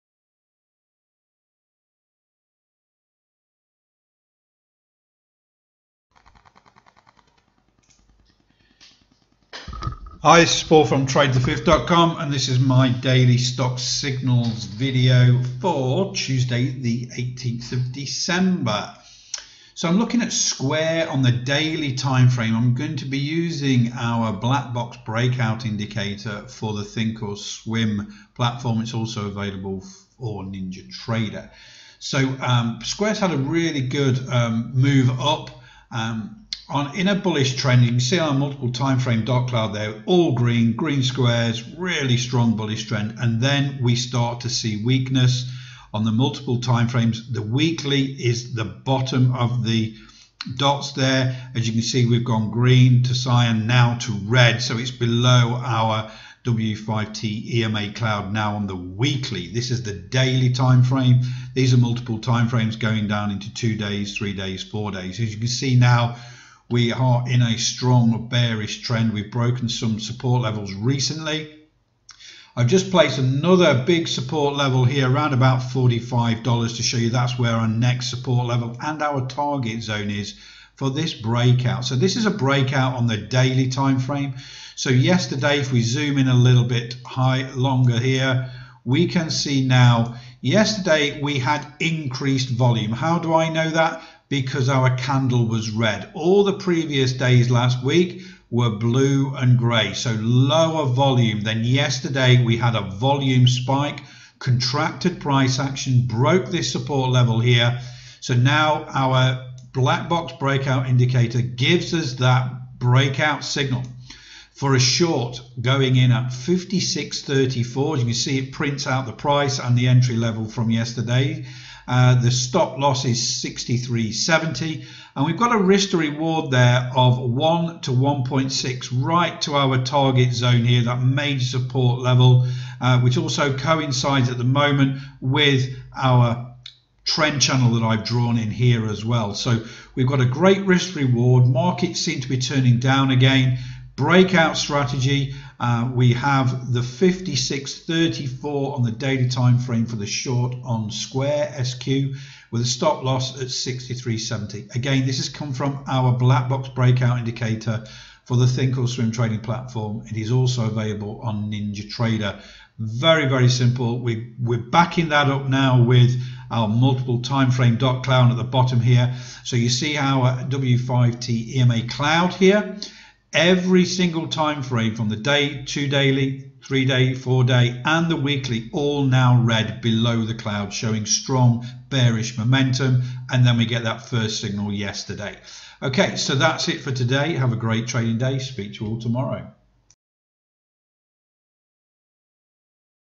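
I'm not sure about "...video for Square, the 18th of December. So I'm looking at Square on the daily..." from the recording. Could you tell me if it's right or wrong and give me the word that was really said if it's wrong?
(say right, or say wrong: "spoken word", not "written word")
wrong: "Tuesday", not "Square".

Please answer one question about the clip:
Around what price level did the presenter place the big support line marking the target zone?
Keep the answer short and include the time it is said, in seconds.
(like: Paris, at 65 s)
$45, at 75 s.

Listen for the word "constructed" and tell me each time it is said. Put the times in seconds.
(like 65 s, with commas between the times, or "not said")
not said.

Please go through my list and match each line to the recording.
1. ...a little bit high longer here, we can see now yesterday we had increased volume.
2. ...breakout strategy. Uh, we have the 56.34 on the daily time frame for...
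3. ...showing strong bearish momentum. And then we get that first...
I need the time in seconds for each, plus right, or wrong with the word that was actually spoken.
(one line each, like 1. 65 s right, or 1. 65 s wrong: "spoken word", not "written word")
1. 86 s right
2. 143 s right
3. 180 s right.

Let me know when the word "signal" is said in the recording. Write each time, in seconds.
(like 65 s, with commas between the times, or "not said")
13 s, 113 s, 184 s.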